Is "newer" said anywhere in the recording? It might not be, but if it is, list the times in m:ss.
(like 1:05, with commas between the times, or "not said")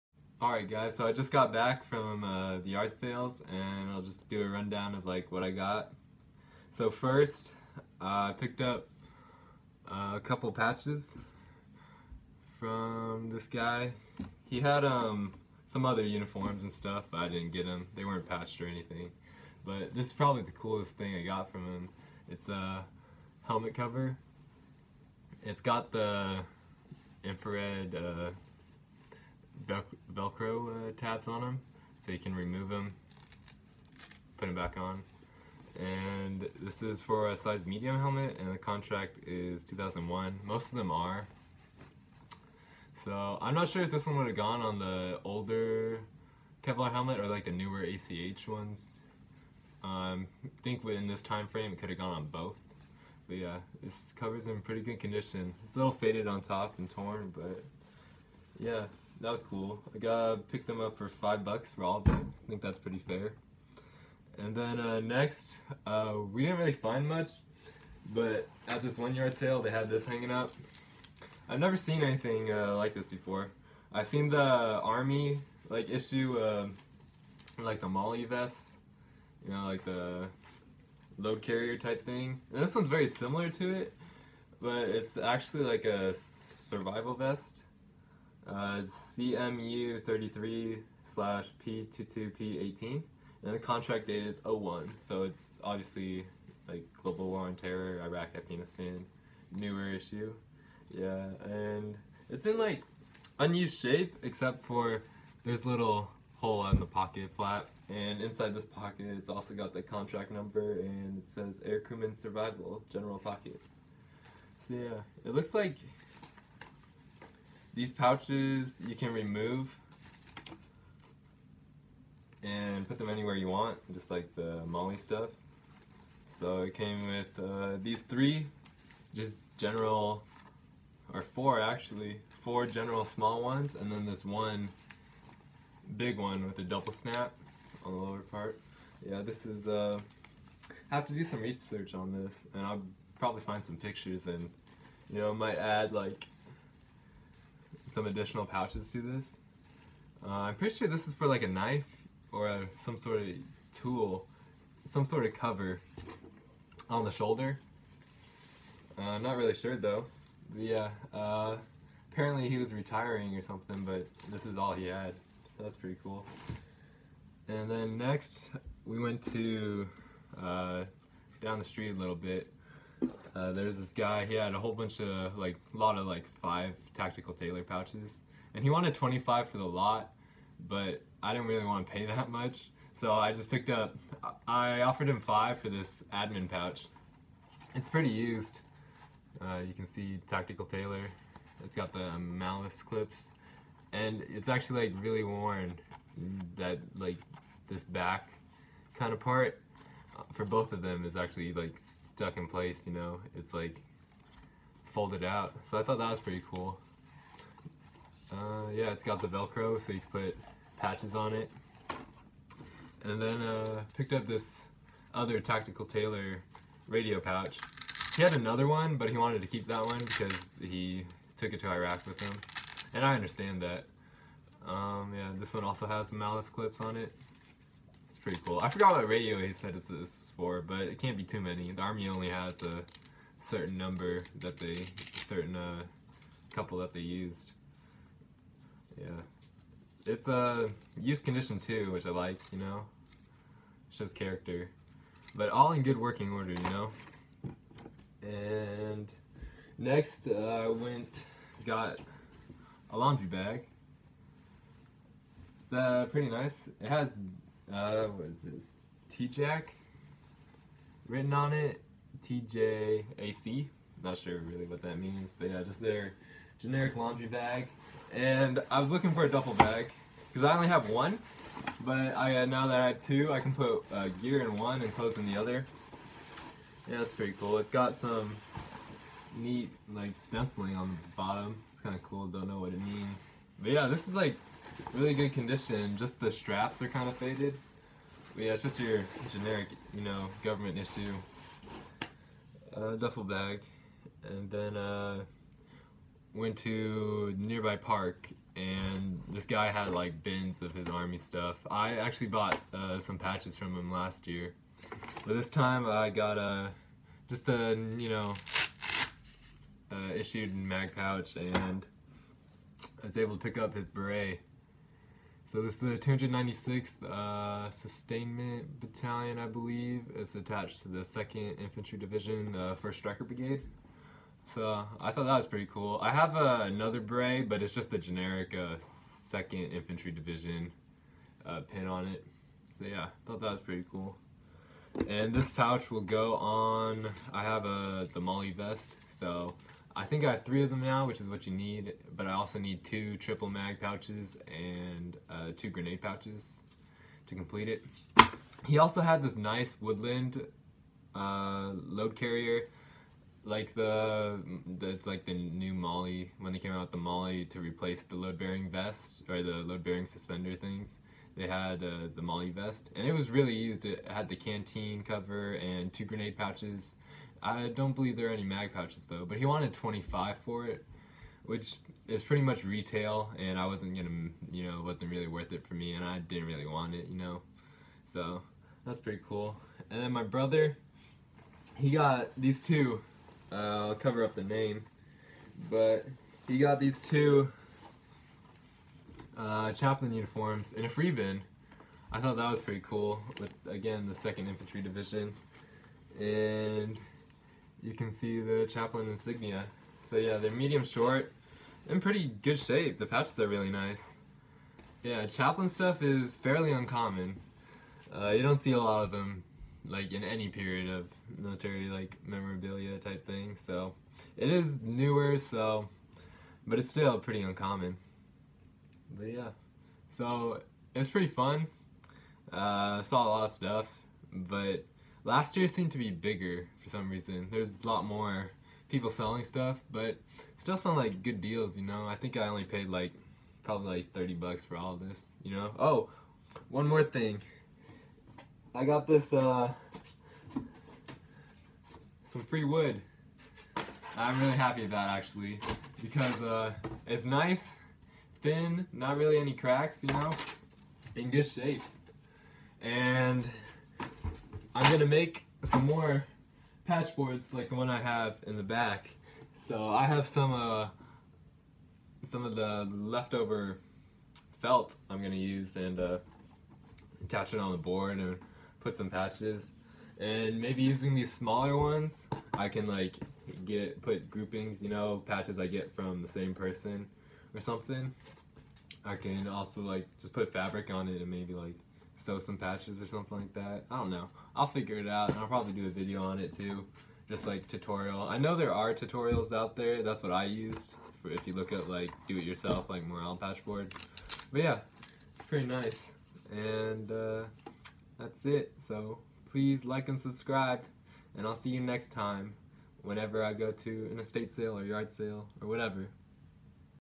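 0:47, 1:39, 6:54.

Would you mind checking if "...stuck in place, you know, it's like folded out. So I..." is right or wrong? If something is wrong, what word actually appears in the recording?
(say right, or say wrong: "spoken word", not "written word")
right.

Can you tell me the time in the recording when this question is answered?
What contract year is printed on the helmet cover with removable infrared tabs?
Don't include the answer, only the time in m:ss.
0:39.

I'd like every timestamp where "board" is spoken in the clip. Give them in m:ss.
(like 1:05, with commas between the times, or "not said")
7:37, 7:47, 8:13.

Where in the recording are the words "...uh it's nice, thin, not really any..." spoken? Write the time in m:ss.
7:26.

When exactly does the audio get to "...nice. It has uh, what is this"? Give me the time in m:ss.
4:16.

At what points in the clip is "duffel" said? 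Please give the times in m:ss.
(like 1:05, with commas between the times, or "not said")
4:29, 4:52.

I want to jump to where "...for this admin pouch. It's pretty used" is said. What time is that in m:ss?
3:05.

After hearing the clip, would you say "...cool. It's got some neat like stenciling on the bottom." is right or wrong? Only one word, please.
right.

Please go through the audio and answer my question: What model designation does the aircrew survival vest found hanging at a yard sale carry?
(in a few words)
CMU 33.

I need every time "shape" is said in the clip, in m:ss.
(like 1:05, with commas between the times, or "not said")
1:43, 6:42, 7:31.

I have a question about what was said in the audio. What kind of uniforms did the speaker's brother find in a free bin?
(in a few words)
chaplain uniforms.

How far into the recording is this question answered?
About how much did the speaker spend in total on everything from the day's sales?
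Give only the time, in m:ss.
7:14.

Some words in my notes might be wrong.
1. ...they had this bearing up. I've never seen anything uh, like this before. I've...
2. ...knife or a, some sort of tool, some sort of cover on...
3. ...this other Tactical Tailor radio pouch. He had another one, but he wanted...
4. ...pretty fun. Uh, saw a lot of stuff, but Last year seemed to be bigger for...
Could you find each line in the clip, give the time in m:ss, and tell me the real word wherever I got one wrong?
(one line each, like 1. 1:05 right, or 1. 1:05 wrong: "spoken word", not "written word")
1. 1:09 wrong: "hanging", not "bearing"
2. 2:31 right
3. 3:34 right
4. 7:01 right.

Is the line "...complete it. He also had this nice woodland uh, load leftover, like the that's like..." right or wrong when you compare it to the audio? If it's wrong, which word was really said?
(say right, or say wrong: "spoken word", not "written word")
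wrong: "carrier", not "leftover".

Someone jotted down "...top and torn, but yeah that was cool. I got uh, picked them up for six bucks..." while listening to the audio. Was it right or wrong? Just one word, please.
wrong.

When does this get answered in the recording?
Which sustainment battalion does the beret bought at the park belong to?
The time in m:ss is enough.
5:15.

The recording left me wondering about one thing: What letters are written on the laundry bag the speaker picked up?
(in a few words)
TJAC.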